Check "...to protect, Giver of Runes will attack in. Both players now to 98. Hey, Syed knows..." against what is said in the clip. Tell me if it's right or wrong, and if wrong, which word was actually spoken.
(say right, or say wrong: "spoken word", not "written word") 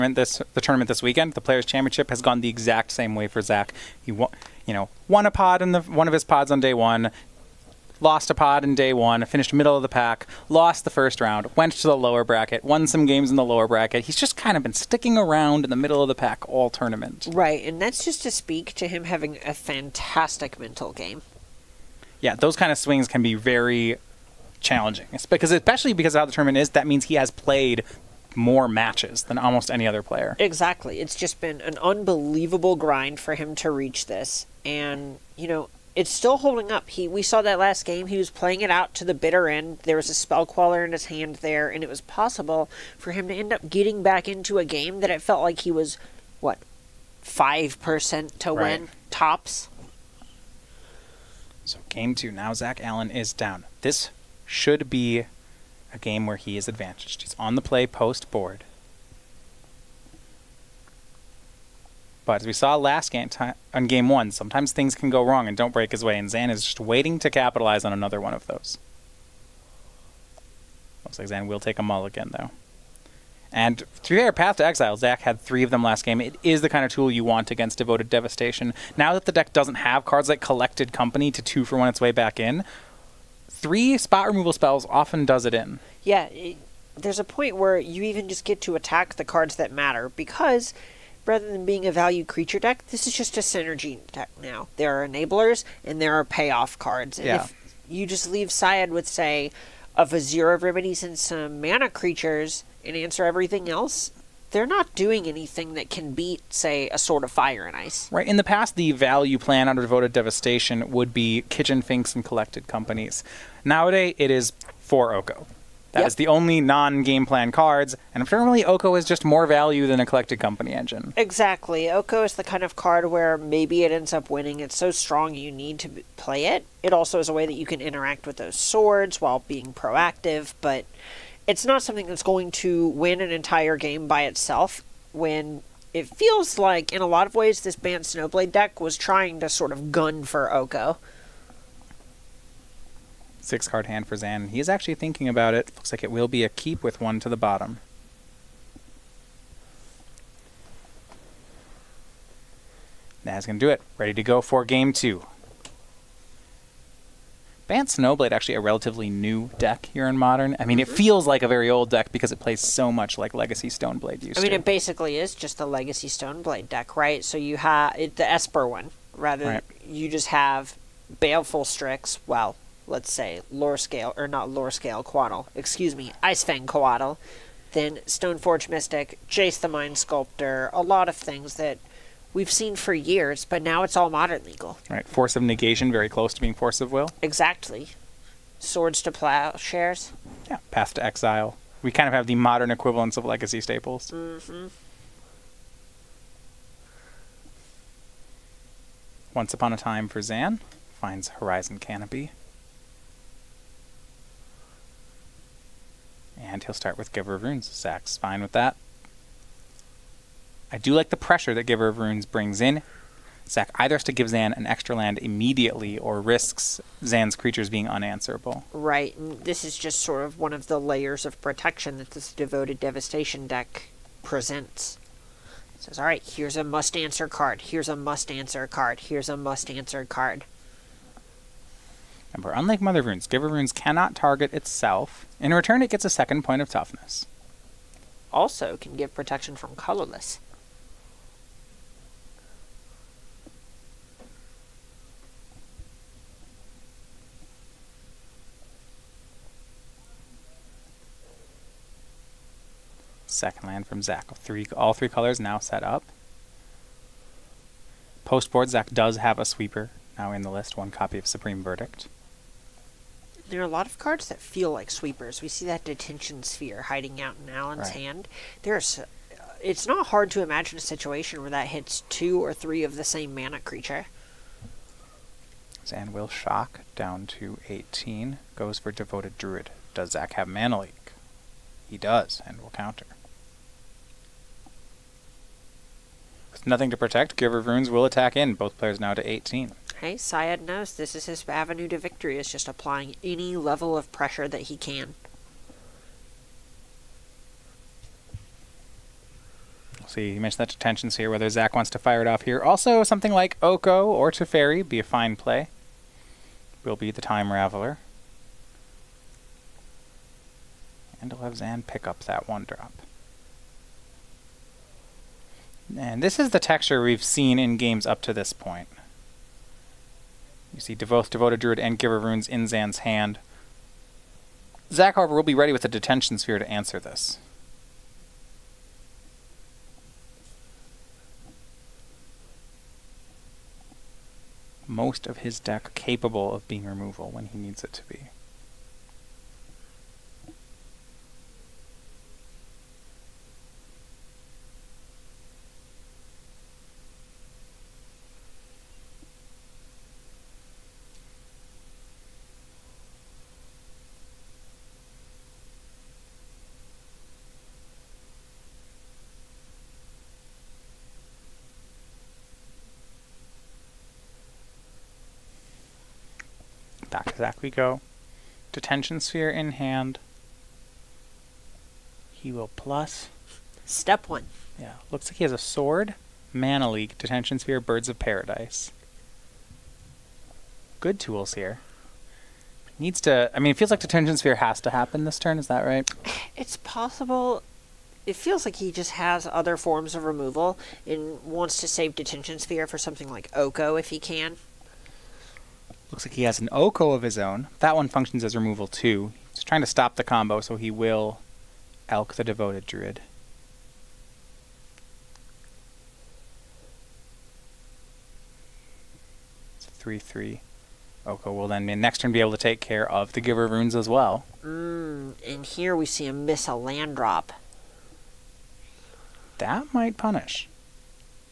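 wrong: "18", not "98".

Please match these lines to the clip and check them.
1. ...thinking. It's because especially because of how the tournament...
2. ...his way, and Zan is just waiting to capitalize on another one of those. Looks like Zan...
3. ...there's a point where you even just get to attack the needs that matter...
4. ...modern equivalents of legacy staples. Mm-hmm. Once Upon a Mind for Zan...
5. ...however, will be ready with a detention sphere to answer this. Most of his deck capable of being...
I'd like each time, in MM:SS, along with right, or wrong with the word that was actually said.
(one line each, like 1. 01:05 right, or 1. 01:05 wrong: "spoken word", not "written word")
1. 00:24 wrong: "challenging", not "thinking"
2. 01:05 right
3. 01:26 wrong: "cards", not "needs"
4. 03:12 wrong: "Time", not "Mind"
5. 05:25 right.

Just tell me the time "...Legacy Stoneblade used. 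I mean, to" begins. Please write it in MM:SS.
02:43.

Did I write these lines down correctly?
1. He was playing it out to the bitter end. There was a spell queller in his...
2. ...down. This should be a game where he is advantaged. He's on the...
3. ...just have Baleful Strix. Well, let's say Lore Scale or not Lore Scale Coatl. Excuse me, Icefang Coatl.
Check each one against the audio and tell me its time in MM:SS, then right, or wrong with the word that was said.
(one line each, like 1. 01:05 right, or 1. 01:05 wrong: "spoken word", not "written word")
1. 00:38 right
2. 00:53 right
3. 02:50 right.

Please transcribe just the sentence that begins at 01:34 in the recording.
There are enablers and there are payoff cards.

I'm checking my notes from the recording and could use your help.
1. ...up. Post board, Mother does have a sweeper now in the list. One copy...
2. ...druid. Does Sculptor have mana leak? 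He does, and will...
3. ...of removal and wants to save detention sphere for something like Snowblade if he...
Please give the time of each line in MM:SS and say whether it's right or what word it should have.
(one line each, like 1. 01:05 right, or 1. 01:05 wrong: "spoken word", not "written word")
1. 04:15 wrong: "Zach", not "Mother"
2. 04:39 wrong: "Zach", not "Sculptor"
3. 06:30 wrong: "Oko", not "Snowblade".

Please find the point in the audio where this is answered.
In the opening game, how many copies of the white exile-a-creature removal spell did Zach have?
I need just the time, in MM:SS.
01:15.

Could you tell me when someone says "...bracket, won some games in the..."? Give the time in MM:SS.
00:12.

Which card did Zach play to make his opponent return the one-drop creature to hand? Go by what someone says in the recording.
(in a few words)
Time Raveler.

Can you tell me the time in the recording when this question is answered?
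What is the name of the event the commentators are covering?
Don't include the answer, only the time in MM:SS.
00:01.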